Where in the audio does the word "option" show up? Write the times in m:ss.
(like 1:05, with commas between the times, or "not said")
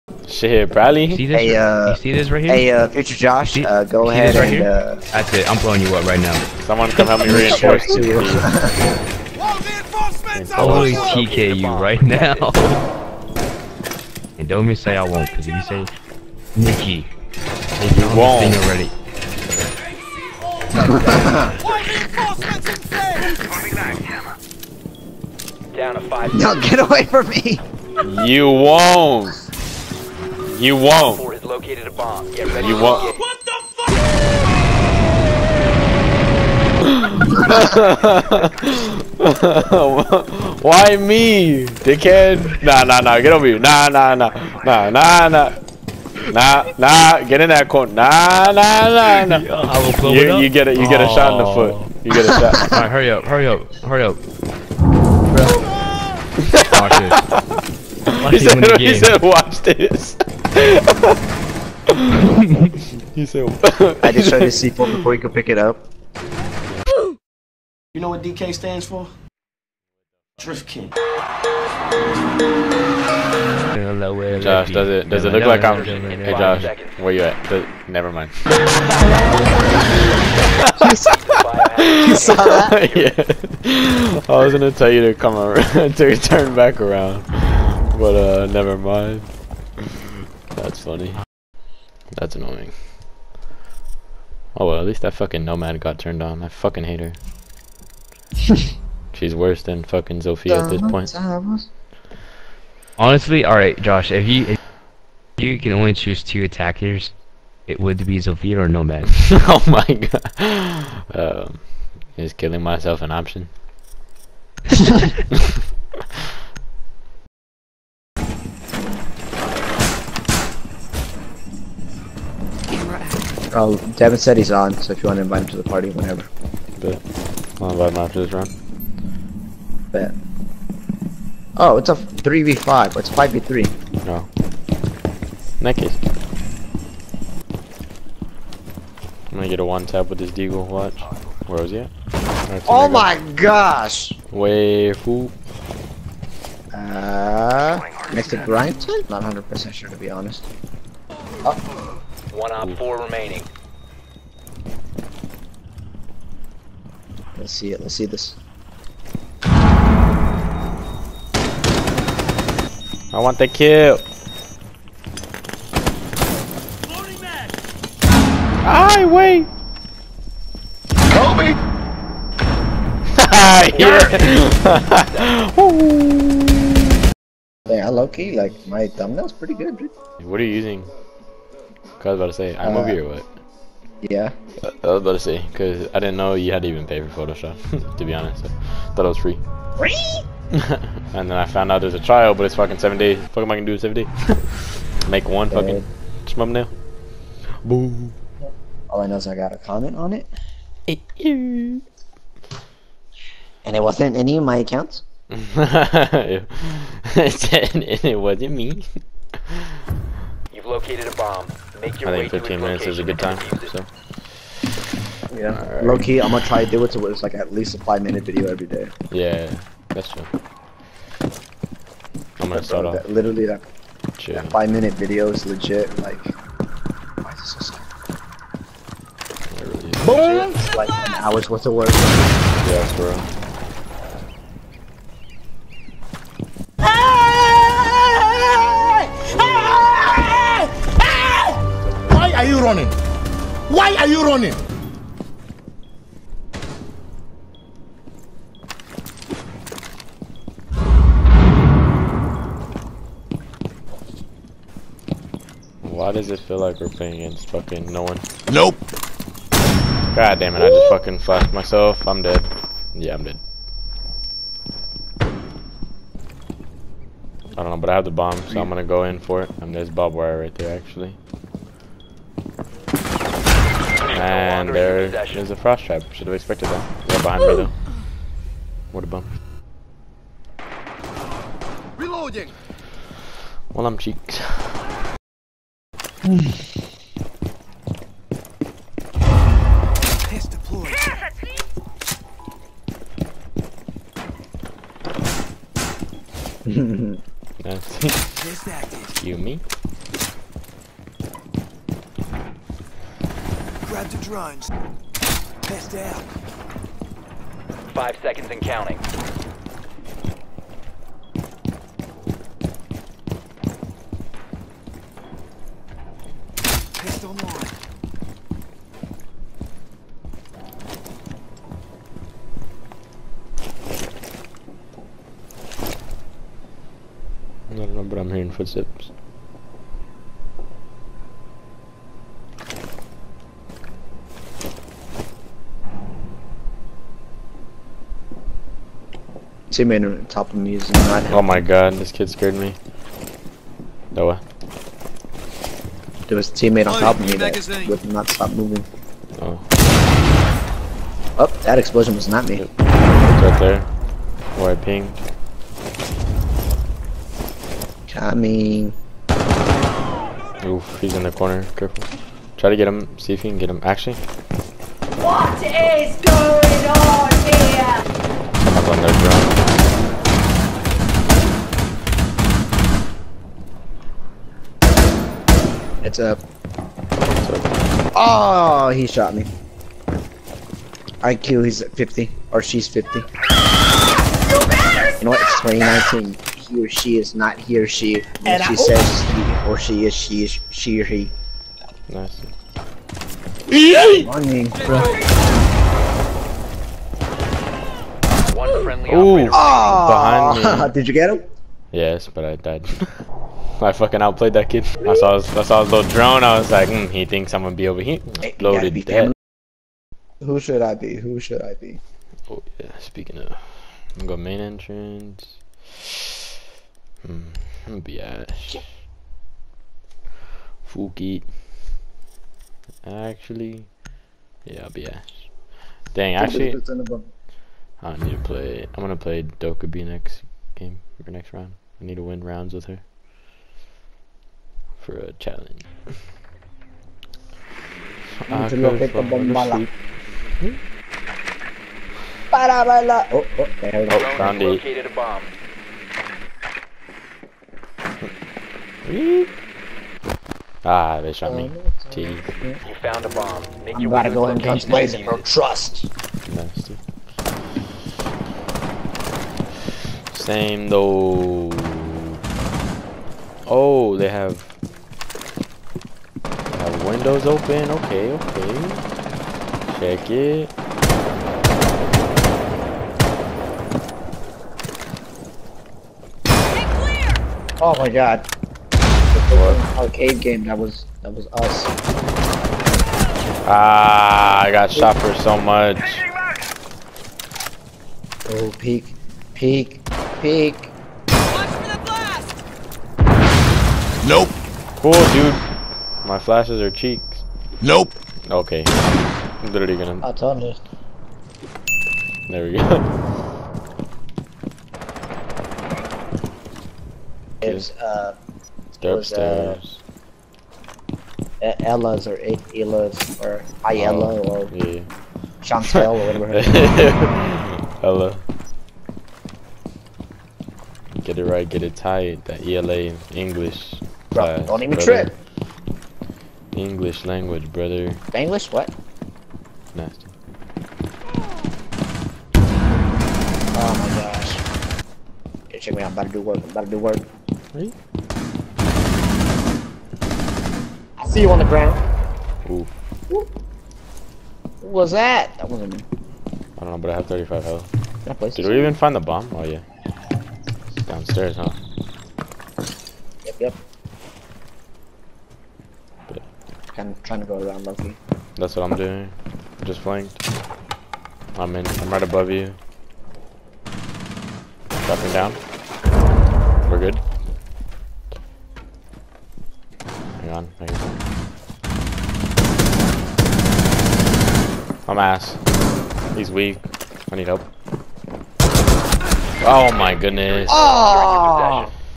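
1:53.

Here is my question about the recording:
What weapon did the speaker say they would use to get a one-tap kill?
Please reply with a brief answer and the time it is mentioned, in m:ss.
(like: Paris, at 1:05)
deagle, at 2:20.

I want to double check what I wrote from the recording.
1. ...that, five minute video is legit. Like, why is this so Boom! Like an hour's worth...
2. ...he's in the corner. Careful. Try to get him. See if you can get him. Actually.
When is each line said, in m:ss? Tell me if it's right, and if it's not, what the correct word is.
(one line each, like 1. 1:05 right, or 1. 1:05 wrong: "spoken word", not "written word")
1. 3:44 right
2. 6:00 right.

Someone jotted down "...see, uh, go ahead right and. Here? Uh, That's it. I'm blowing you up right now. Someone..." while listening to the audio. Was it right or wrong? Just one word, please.
right.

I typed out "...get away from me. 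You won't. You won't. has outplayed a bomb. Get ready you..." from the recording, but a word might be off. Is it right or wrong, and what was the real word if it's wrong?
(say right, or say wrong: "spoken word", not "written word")
wrong: "located", not "outplayed".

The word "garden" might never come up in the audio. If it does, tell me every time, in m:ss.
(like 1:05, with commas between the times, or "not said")
not said.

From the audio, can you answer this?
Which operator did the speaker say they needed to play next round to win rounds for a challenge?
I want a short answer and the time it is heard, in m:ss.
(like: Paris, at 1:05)
Dokkaebi, at 7:09.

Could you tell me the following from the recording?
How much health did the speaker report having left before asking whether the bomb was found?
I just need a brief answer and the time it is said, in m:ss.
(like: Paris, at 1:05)
35, at 9:07.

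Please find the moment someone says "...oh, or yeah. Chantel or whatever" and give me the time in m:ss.
8:34.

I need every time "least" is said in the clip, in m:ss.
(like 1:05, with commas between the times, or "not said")
1:34, 3:37.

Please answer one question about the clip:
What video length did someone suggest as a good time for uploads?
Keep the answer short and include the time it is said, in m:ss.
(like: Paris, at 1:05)
15 minutes, at 3:32.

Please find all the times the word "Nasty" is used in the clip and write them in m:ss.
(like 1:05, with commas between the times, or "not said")
7:36, 8:49.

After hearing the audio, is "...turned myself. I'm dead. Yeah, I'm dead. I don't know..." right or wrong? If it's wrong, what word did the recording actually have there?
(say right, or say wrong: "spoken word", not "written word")
wrong: "flashed", not "turned".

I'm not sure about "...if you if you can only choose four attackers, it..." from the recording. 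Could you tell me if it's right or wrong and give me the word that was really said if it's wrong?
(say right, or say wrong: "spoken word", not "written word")
wrong: "two", not "four".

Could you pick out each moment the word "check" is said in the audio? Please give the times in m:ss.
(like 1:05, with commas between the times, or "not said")
7:49, 8:55.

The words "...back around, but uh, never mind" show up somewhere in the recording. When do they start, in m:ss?
1:26.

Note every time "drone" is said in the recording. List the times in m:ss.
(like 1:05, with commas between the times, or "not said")
5:04, 6:09, 6:46.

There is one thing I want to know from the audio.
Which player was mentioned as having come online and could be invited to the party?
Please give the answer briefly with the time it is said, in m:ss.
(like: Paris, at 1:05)
Devin, at 2:03.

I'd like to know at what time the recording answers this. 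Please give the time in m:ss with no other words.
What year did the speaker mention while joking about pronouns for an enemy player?
6:25.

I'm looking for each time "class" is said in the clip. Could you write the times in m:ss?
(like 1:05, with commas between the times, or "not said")
8:44.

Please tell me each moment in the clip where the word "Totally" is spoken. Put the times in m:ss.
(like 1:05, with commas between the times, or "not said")
0:10.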